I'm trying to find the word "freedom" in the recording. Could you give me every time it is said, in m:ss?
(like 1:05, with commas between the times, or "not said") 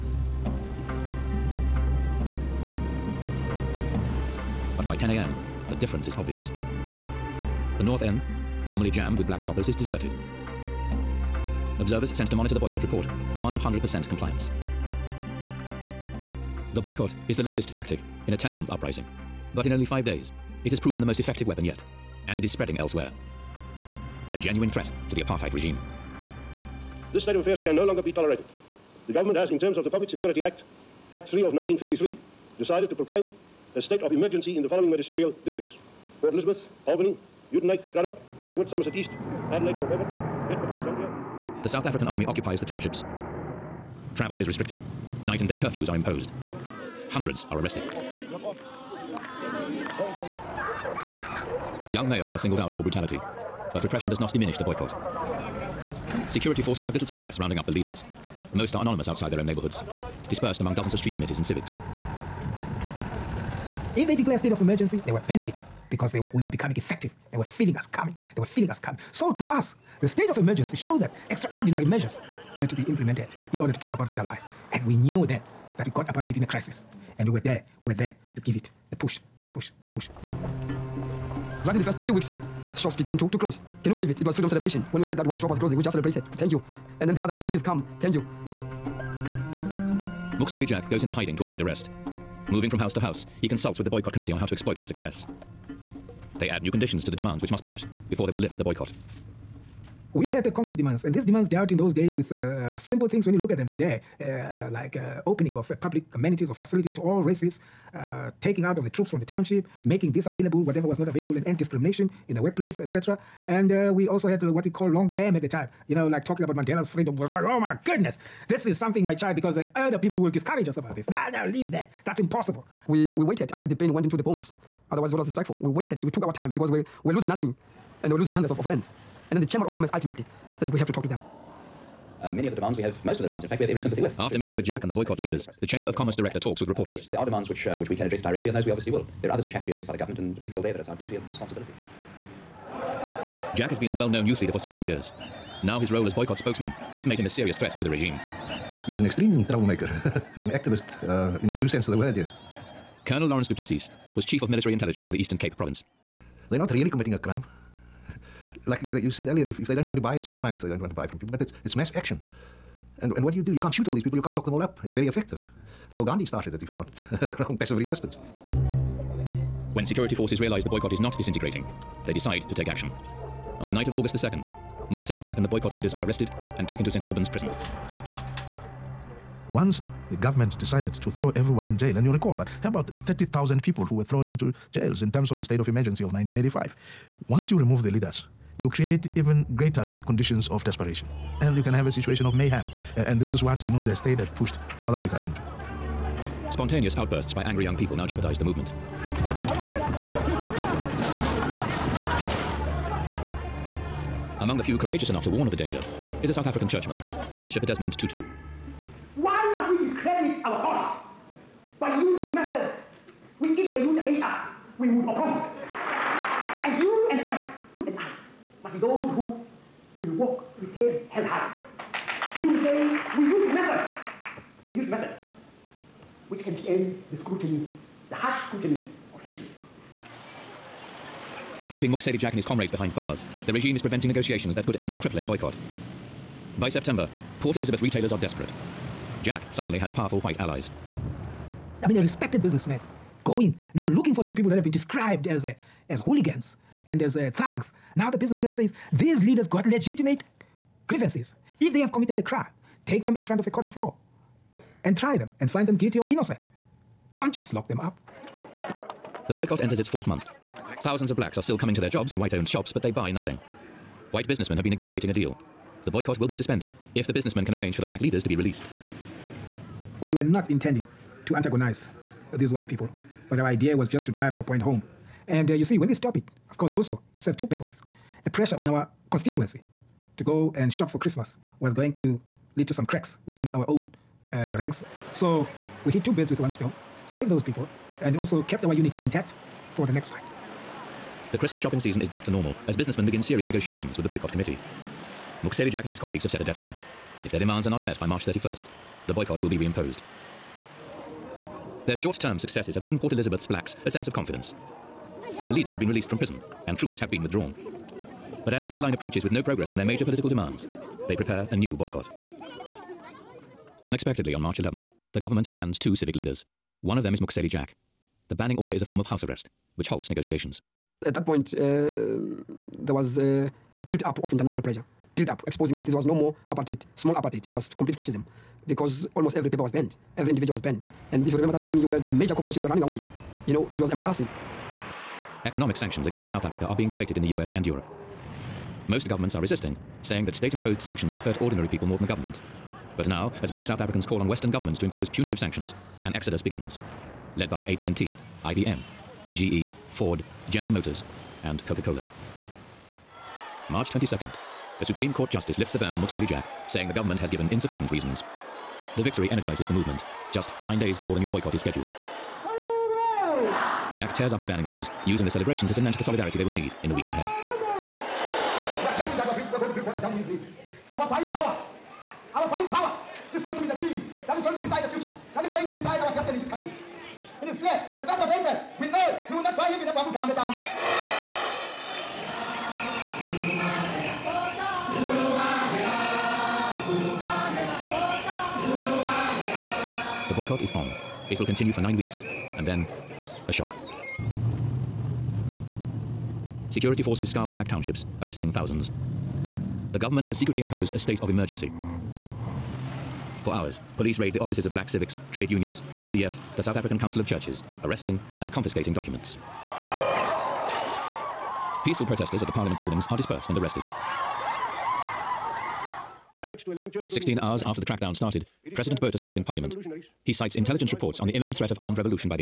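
1:24, 1:56.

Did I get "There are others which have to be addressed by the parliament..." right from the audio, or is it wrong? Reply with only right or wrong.
wrong.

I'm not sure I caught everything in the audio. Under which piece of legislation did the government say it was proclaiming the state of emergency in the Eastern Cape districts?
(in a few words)
Public Security Act.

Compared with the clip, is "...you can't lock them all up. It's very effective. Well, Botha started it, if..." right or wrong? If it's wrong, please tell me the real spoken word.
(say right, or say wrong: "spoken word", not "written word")
wrong: "Gandhi", not "Botha".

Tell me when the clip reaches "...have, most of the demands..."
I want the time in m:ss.
2:12.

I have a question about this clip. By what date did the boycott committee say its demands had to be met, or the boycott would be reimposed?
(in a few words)
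March 31st.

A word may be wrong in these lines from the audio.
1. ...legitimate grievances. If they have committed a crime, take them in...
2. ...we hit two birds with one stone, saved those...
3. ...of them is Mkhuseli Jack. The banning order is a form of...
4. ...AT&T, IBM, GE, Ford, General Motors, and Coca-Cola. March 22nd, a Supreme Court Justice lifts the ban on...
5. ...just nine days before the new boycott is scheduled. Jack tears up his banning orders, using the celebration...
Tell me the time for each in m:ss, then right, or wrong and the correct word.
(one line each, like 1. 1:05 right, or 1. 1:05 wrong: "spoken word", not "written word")
1. 4:09 right
2. 4:45 right
3. 5:16 right
4. 5:47 right
5. 6:00 right.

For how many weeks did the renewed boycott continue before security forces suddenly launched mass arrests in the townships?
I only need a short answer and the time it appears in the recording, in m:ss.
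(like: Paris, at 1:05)
9, at 6:31.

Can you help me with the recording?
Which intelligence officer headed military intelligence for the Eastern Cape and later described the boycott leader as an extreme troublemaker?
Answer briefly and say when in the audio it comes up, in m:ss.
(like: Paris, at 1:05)
Lawrence Duplessis, at 2:33.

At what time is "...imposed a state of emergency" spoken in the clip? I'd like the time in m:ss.
6:40.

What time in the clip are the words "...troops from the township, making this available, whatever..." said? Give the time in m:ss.
1:48.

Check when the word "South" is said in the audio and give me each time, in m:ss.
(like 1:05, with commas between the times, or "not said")
0:41, 3:14, 3:26, 5:36, 5:43, 6:46.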